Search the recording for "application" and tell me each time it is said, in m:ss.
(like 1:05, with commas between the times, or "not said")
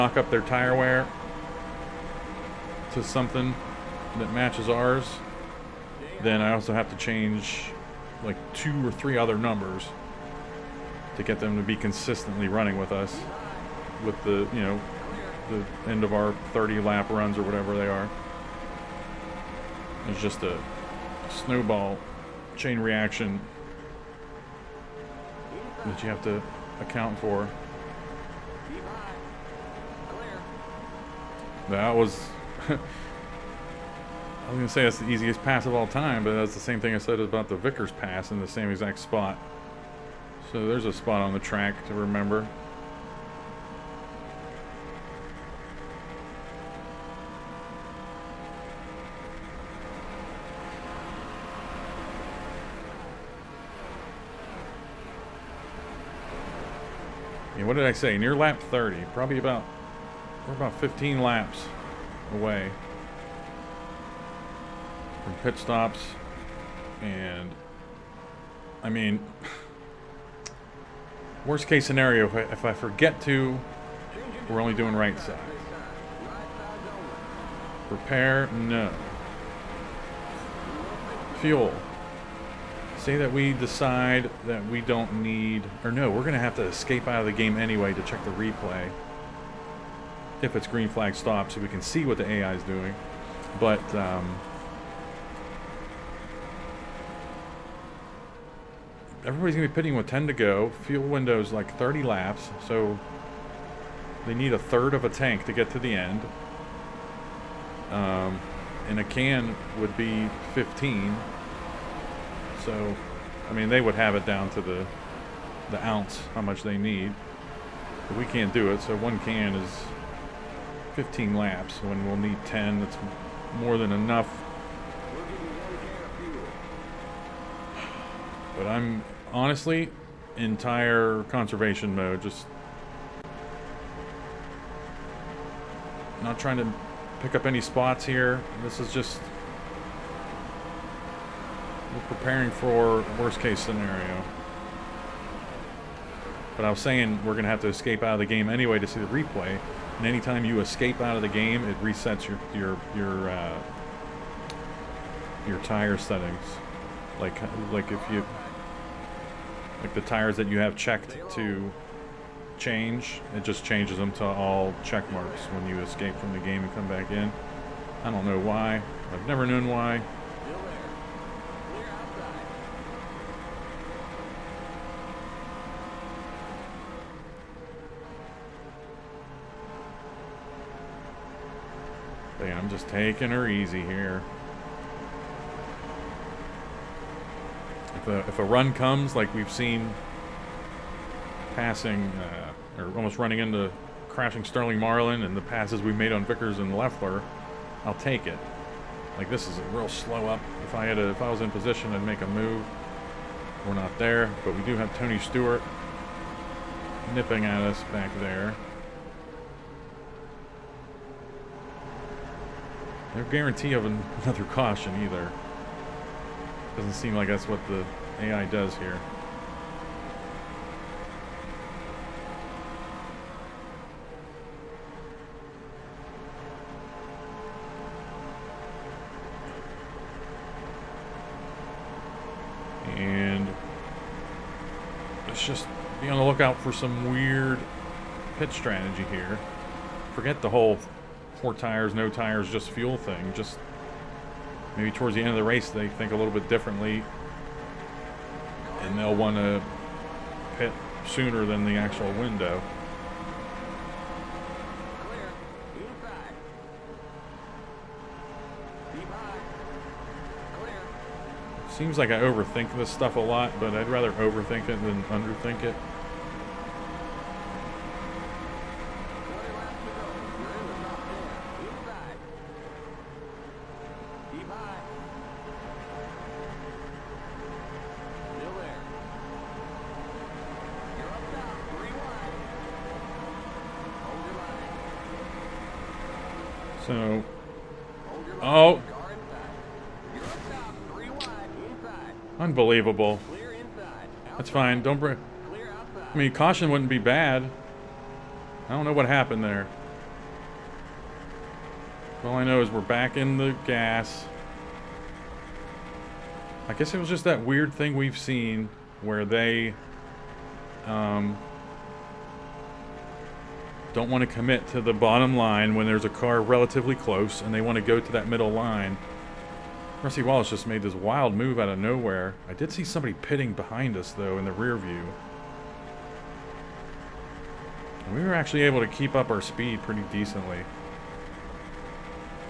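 not said.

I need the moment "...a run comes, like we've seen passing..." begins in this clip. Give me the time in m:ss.
3:08.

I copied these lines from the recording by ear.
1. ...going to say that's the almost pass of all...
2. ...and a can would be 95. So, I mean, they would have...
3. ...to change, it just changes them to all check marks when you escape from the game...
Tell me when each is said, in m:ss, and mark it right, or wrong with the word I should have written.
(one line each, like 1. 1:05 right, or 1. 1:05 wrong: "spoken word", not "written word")
1. 0:34 wrong: "easiest", not "almost"
2. 1:48 wrong: "15", not "95"
3. 2:41 right.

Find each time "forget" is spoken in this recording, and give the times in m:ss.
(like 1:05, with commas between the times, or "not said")
1:12, 4:00.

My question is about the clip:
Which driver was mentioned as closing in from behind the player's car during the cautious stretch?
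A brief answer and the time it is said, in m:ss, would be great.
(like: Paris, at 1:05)
Tony Stewart, at 3:24.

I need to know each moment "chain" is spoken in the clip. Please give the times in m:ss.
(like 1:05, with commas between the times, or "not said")
0:22.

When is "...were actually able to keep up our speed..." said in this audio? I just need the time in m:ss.
5:28.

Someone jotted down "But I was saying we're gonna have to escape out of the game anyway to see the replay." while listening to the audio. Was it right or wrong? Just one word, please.
right.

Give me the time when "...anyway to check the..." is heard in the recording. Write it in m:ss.
1:27.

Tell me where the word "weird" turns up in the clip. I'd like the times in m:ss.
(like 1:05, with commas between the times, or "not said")
3:57, 5:07.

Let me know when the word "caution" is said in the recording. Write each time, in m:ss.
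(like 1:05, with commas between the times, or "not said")
3:34, 4:56.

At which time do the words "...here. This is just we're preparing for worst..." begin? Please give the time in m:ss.
2:18.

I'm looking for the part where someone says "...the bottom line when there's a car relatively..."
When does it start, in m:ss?
5:14.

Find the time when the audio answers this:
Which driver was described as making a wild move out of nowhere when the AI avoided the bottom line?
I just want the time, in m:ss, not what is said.
5:20.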